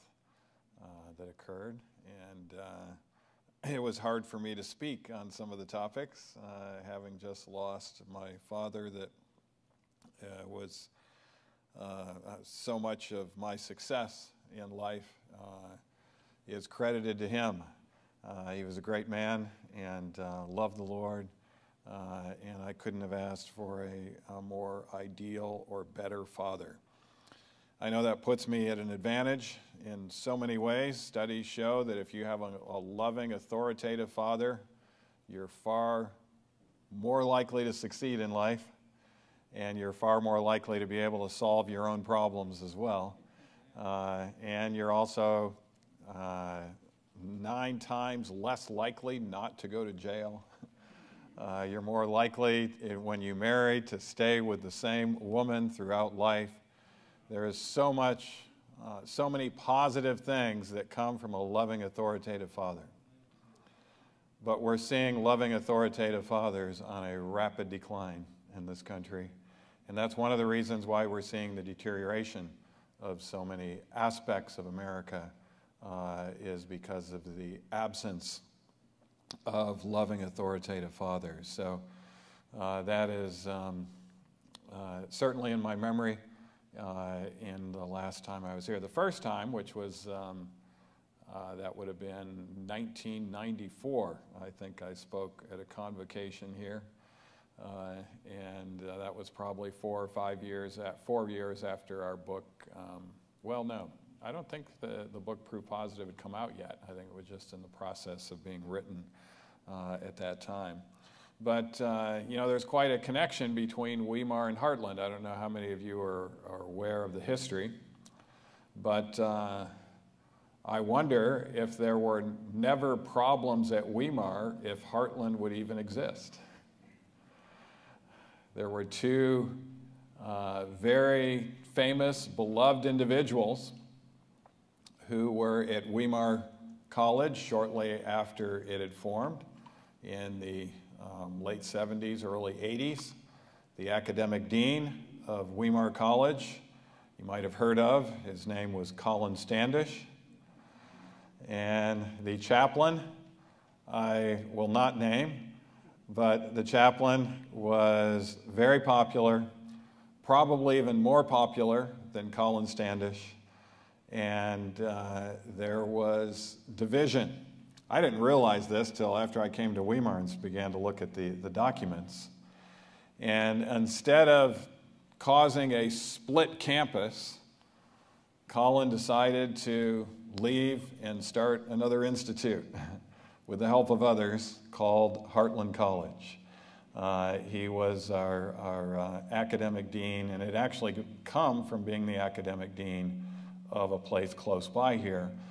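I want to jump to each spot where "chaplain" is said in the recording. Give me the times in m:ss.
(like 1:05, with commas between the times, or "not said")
2:32, 2:36.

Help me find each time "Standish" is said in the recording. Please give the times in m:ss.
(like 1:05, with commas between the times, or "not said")
2:29, 2:42.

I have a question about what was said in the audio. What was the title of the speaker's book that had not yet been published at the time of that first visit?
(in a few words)
Proof Positive.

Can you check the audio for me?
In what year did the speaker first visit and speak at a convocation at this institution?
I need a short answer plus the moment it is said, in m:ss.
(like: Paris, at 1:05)
1994, at 1:32.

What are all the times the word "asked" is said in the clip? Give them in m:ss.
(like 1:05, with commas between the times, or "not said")
0:23.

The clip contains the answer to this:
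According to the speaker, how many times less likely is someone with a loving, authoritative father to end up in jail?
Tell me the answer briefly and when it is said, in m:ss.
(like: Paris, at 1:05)
9, at 0:47.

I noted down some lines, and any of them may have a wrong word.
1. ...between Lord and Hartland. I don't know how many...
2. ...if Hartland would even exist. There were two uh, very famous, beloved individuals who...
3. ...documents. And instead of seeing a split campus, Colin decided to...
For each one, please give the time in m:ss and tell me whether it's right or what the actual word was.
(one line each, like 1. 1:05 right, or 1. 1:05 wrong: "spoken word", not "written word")
1. 1:53 wrong: "Weimar", not "Lord"
2. 2:04 right
3. 2:51 wrong: "causing", not "seeing".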